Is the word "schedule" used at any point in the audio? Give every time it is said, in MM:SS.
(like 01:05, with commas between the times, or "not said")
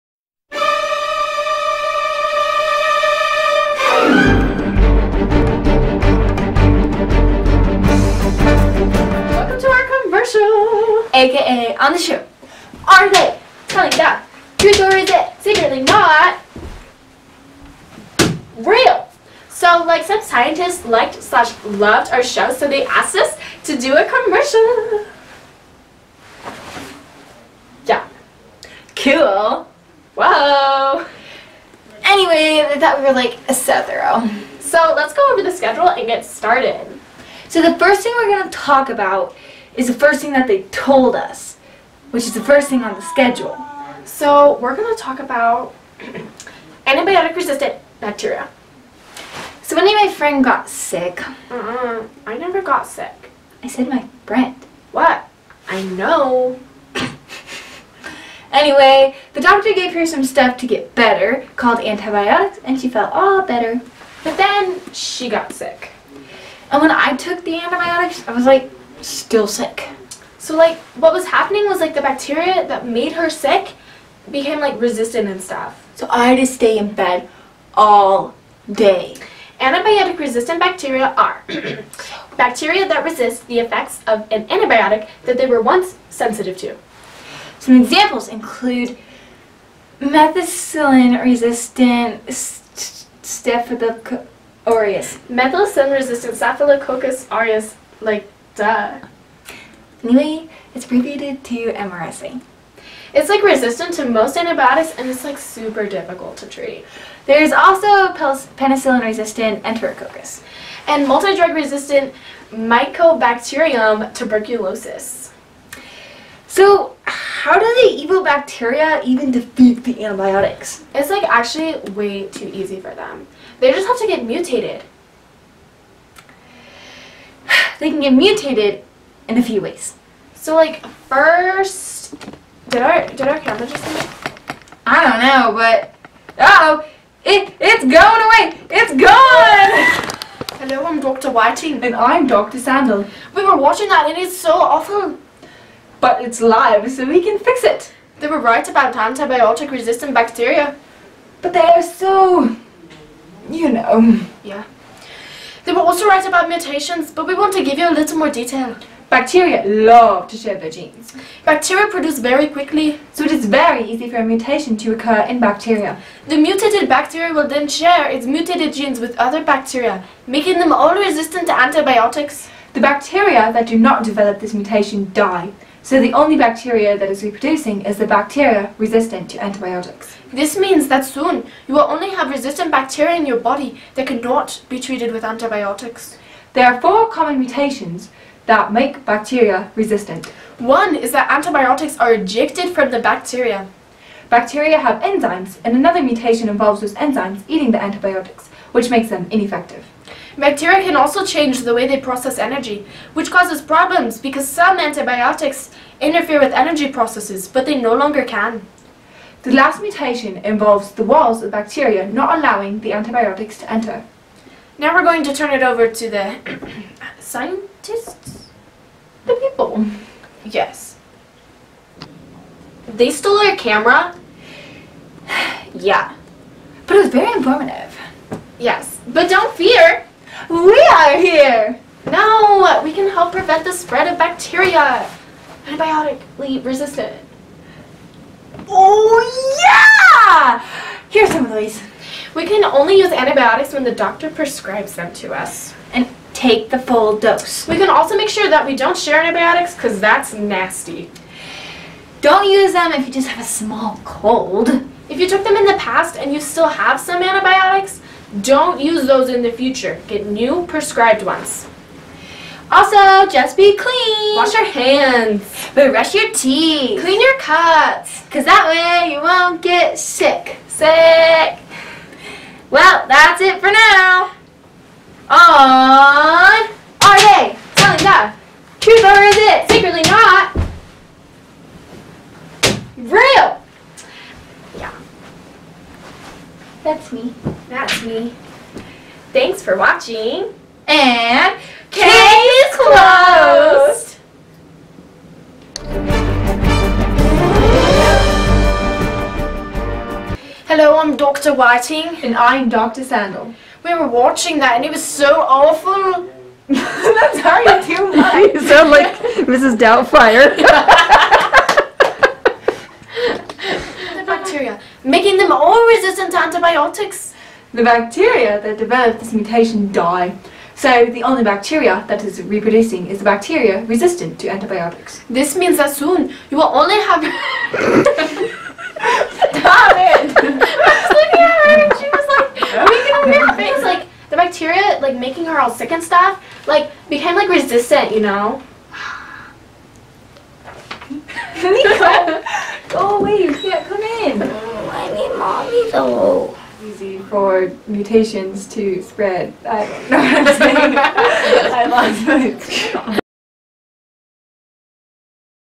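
00:35, 00:43.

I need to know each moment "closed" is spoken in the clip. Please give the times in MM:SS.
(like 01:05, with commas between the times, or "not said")
04:52.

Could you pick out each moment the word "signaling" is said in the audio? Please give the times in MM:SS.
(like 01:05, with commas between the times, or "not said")
not said.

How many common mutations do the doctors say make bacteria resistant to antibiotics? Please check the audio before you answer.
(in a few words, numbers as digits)
4.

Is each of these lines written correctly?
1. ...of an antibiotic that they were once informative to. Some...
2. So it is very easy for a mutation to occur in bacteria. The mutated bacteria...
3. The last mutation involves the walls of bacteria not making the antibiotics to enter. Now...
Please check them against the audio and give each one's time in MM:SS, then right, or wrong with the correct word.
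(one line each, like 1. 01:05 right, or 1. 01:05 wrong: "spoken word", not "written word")
1. 01:24 wrong: "sensitive", not "informative"
2. 02:43 right
3. 03:29 wrong: "allowing", not "making".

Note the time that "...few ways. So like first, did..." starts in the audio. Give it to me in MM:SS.
02:09.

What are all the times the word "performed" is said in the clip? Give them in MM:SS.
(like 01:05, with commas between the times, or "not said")
not said.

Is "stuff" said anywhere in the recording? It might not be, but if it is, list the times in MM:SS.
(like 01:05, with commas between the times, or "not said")
01:00, 01:15, 05:36.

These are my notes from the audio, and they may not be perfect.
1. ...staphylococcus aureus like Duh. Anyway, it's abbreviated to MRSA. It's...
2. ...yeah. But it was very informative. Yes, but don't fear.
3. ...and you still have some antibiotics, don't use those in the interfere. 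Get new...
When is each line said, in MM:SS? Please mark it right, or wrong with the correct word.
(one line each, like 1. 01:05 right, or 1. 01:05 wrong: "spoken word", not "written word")
1. 01:36 right
2. 03:45 right
3. 04:16 wrong: "future", not "interfere".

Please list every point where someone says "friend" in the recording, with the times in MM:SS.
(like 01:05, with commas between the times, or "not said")
00:50, 00:54.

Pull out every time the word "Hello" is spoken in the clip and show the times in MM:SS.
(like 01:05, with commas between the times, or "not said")
02:20, 05:00.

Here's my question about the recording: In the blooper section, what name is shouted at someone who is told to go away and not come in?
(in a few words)
Nico.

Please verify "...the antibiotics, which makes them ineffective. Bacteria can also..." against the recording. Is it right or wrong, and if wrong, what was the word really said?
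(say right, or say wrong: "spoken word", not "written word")
right.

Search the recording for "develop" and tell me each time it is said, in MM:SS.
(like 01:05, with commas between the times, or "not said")
02:54, 05:18.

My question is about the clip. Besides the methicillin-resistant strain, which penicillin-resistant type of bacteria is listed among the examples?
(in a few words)
enterococcus.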